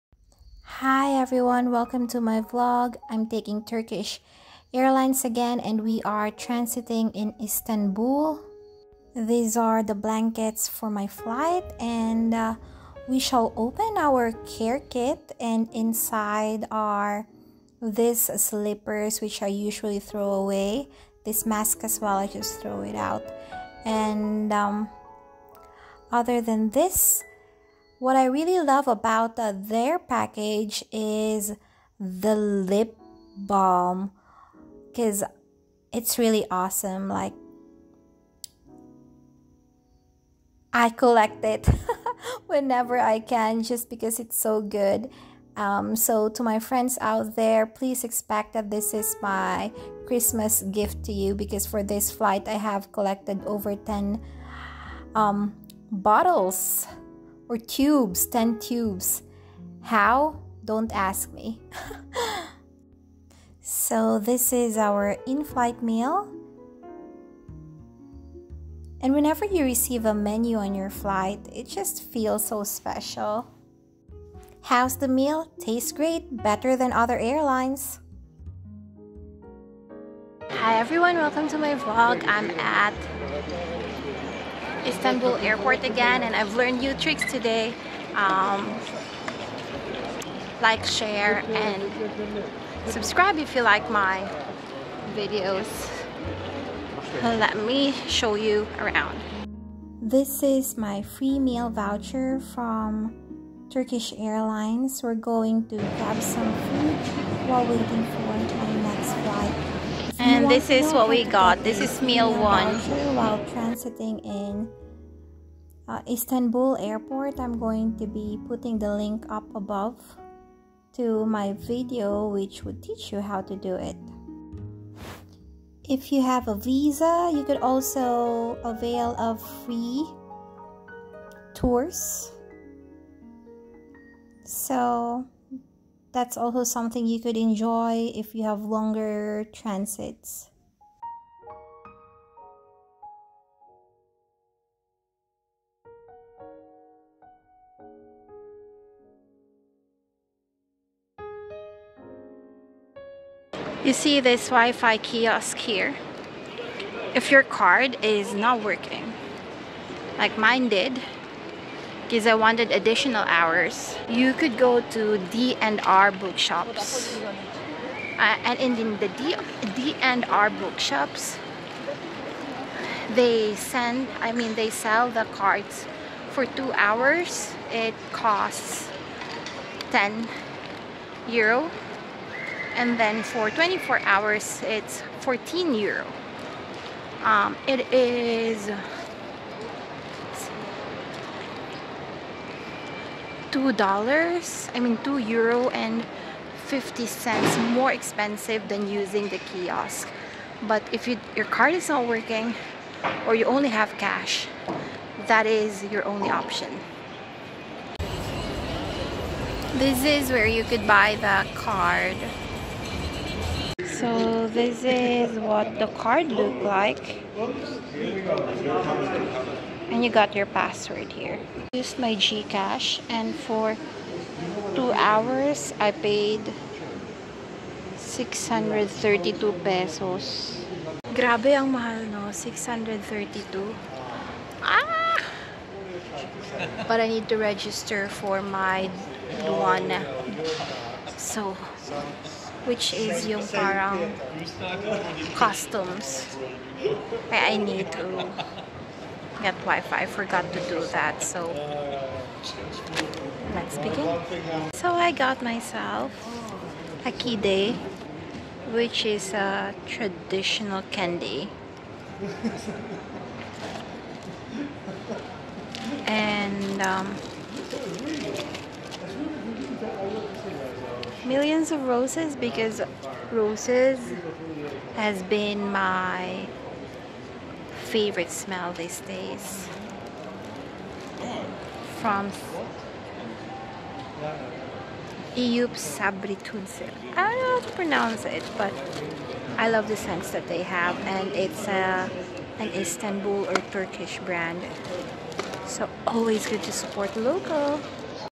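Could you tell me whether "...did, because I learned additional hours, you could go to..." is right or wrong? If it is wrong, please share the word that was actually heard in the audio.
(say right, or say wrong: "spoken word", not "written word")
wrong: "wanted", not "learned".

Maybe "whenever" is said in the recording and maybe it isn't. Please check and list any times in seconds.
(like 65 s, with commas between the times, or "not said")
42 s, 69 s.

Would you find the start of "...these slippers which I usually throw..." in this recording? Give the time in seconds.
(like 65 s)
17 s.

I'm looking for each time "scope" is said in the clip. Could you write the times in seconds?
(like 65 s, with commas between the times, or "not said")
not said.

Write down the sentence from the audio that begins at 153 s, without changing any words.
You see this Wi-Fi kiosk here.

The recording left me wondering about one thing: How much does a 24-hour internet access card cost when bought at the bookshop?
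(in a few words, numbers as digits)
14 euro.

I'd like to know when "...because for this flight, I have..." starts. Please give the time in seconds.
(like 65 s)
51 s.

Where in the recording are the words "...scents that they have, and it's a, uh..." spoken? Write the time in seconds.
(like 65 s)
289 s.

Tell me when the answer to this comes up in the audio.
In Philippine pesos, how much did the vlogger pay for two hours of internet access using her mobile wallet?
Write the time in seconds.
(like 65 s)
227 s.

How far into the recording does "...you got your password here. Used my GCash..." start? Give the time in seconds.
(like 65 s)
220 s.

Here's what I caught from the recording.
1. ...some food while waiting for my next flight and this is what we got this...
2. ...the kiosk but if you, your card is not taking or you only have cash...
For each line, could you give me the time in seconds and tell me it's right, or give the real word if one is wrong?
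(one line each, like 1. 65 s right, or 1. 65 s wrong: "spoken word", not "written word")
1. 106 s right
2. 199 s wrong: "working", not "taking".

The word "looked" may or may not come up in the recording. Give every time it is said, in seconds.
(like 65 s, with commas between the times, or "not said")
216 s.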